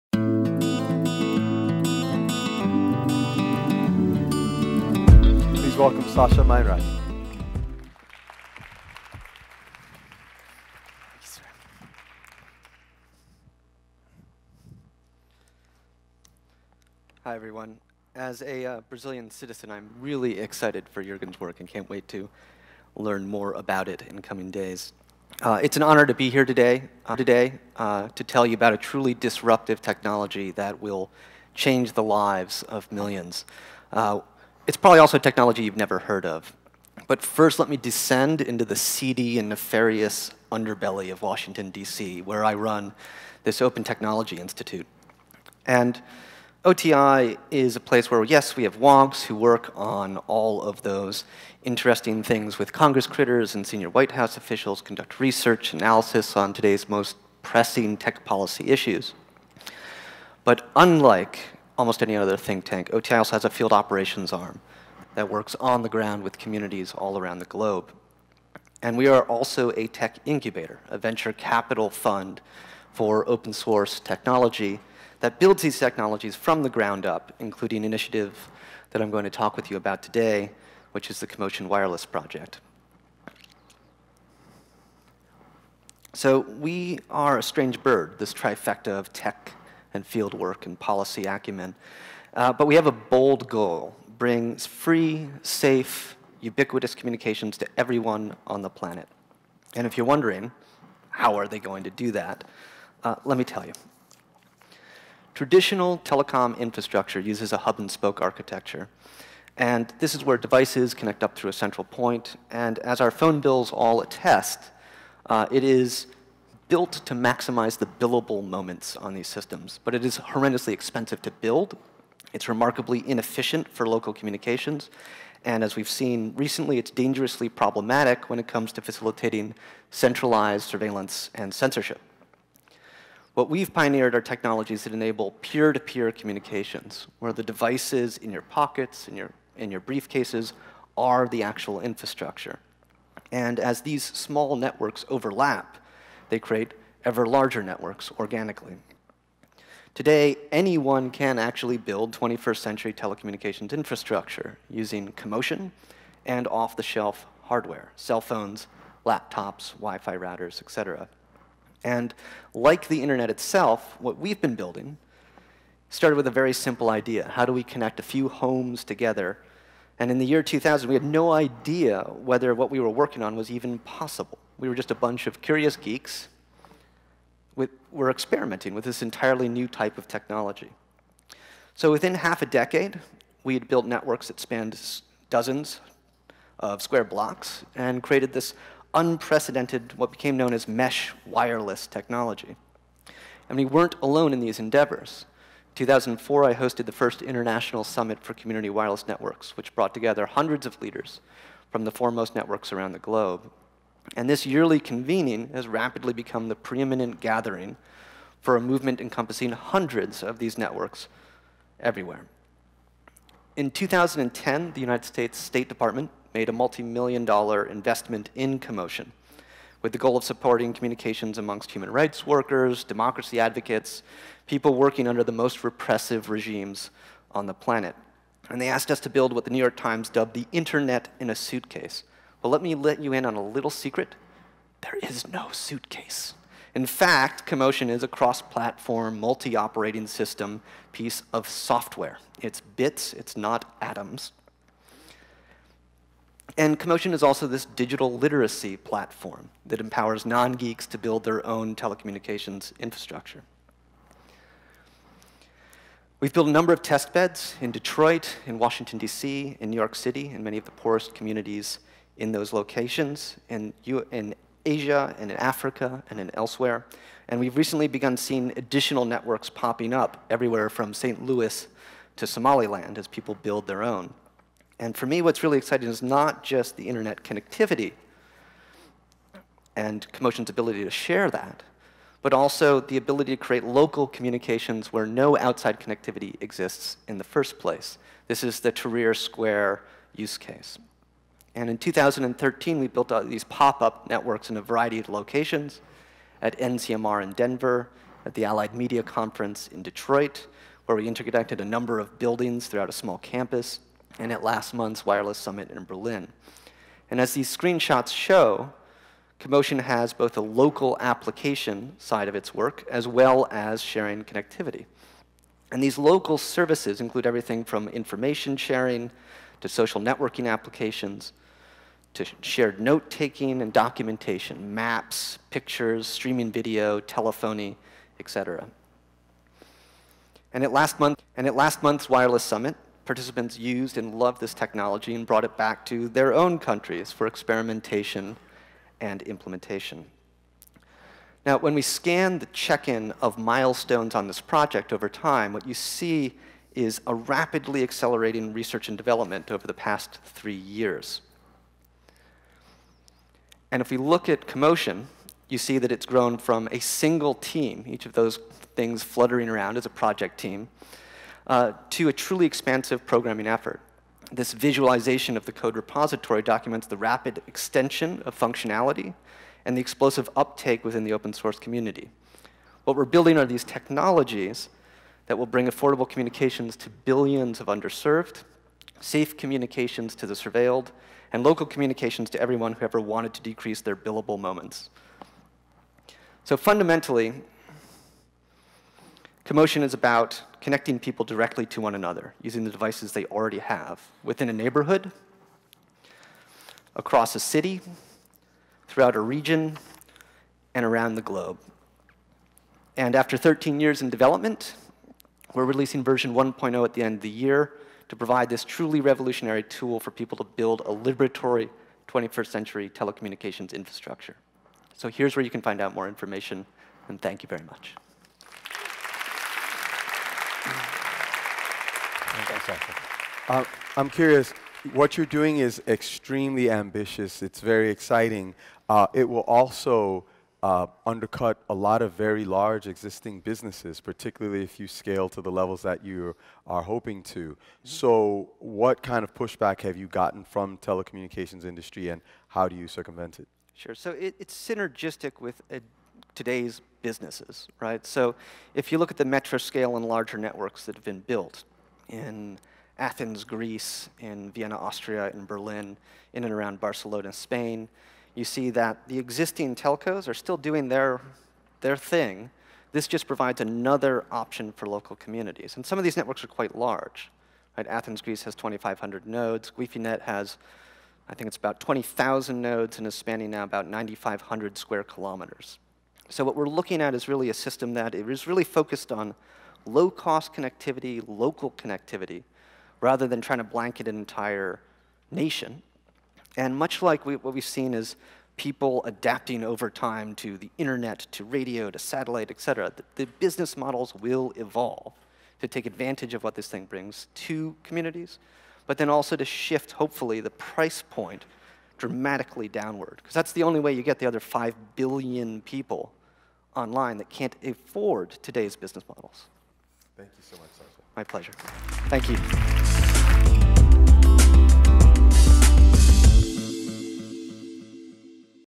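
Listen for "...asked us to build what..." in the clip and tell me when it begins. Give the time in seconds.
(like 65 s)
228 s.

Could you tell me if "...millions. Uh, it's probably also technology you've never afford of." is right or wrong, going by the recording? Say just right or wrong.
wrong.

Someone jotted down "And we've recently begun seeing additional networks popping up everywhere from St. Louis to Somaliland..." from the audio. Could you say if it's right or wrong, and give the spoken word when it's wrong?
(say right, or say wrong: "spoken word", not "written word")
right.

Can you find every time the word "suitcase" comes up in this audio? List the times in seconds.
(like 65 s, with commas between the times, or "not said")
231 s, 235 s.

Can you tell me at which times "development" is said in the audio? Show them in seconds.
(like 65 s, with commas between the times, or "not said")
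348 s, 404 s.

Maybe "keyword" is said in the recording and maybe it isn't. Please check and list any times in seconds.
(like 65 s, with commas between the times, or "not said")
not said.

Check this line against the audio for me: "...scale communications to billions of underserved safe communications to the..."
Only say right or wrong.
wrong.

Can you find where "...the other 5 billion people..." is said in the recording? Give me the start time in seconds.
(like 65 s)
504 s.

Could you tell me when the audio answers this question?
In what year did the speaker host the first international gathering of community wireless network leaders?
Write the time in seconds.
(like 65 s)
195 s.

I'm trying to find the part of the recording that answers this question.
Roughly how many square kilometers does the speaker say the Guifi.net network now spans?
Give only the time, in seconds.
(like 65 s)
473 s.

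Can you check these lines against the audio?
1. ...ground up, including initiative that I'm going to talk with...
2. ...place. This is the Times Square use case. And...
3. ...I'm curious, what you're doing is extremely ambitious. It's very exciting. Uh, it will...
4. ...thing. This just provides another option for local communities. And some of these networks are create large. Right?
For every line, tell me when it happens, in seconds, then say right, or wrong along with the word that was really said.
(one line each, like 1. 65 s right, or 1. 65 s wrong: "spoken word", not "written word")
1. 76 s right
2. 287 s wrong: "Tahrir", not "Times"
3. 423 s right
4. 461 s wrong: "quite", not "create".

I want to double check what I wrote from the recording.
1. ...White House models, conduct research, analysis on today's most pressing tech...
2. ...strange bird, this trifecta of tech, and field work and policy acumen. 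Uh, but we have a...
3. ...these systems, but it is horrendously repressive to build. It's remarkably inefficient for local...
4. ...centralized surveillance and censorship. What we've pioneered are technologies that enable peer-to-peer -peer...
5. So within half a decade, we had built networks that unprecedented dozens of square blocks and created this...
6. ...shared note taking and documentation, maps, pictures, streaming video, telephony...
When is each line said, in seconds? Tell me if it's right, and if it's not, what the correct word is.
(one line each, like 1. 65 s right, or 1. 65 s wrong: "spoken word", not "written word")
1. 53 s wrong: "officials", not "models"
2. 87 s right
3. 119 s wrong: "expensive", not "repressive"
4. 129 s right
5. 181 s wrong: "spanned", not "unprecedented"
6. 322 s right.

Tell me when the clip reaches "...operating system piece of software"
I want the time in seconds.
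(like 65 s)
239 s.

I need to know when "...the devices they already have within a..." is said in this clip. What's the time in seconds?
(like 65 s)
392 s.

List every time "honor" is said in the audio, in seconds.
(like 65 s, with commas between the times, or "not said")
25 s.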